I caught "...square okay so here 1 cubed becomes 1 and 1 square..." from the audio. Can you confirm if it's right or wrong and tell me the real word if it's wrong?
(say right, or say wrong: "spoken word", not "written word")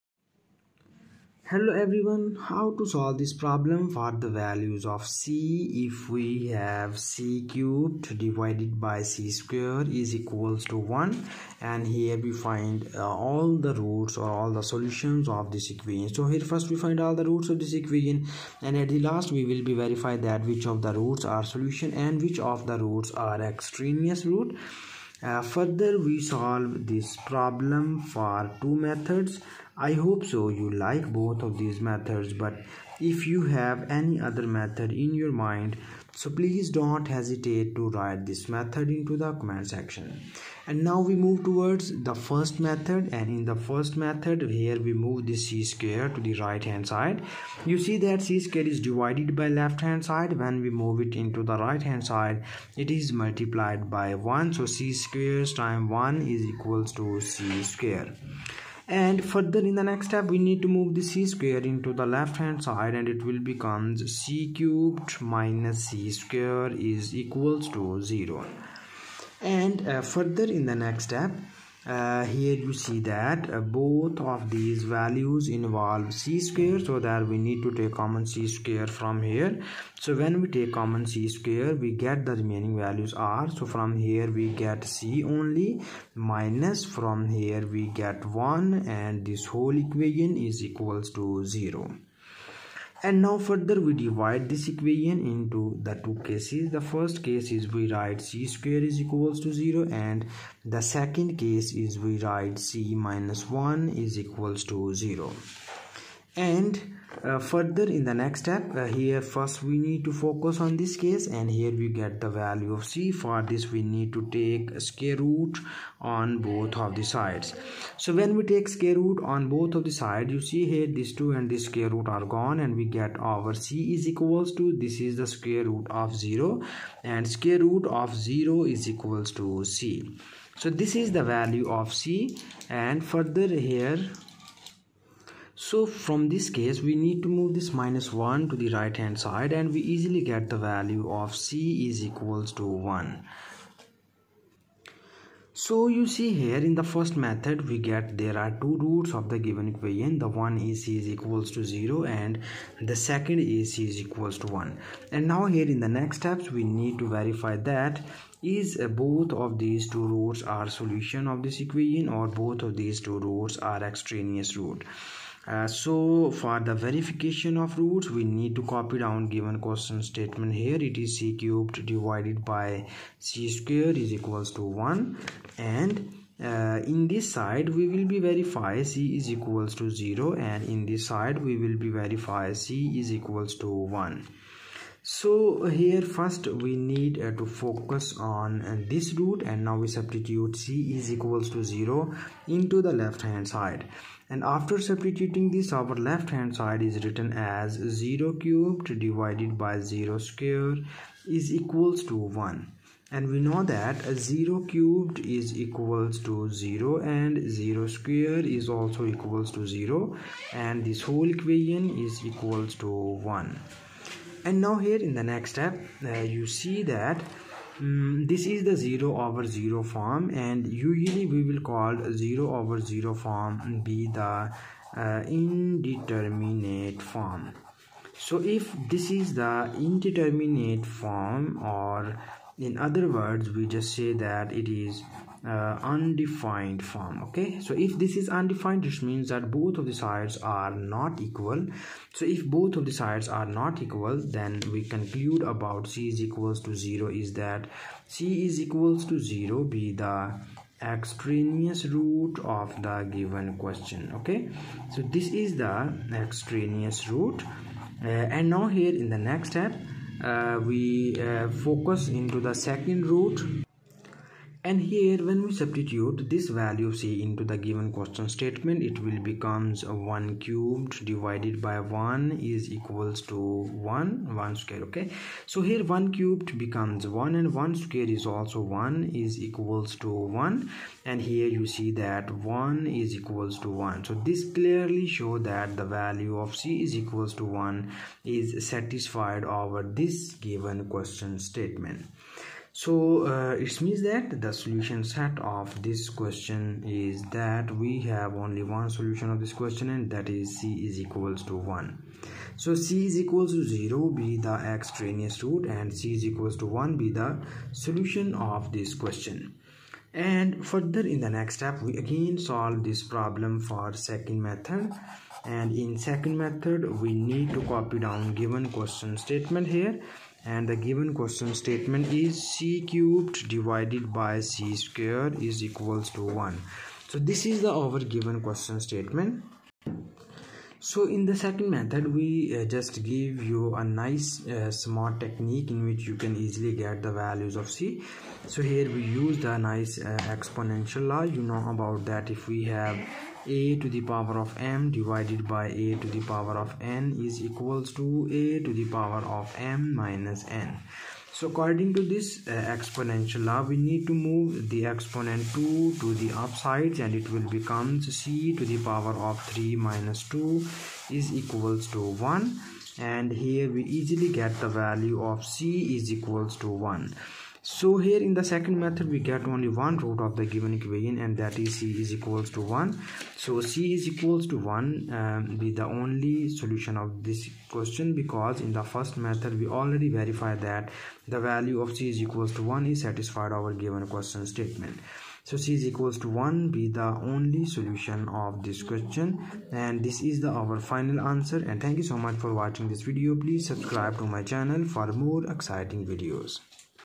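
right.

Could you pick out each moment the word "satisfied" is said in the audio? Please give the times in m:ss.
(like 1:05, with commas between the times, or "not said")
4:48, 6:23.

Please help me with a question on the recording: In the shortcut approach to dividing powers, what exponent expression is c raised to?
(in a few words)
3 minus 2.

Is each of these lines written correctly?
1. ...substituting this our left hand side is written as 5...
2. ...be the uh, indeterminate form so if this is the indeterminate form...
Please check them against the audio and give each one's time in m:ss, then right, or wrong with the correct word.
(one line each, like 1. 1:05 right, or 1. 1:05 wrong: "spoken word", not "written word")
1. 3:14 wrong: "0", not "5"
2. 3:43 right.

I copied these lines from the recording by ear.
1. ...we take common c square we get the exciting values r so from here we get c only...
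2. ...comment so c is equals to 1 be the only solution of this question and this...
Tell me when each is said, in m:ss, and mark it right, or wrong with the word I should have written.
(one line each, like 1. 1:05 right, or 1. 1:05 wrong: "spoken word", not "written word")
1. 1:20 wrong: "remaining", not "exciting"
2. 6:24 wrong: "statement", not "comment".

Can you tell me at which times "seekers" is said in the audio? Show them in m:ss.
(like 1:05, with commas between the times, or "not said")
not said.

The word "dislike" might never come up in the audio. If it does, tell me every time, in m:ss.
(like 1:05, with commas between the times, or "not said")
not said.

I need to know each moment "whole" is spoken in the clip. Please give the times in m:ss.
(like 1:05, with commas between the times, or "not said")
1:29, 3:31.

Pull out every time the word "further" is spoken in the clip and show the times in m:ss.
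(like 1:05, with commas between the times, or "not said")
0:25, 0:59, 1:10, 1:33, 1:47, 2:13, 5:10.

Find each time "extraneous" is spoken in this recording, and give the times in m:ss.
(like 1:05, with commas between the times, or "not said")
0:23, 2:43, 4:10, 4:16, 5:04.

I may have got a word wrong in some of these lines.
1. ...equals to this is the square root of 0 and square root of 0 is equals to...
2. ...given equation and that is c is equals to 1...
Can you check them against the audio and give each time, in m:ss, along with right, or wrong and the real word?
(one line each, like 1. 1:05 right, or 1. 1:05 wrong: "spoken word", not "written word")
1. 2:04 right
2. 6:10 right.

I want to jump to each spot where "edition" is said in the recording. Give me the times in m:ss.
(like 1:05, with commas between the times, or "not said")
not said.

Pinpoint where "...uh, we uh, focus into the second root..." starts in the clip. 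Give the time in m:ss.
4:20.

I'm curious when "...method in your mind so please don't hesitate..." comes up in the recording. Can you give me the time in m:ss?
0:34.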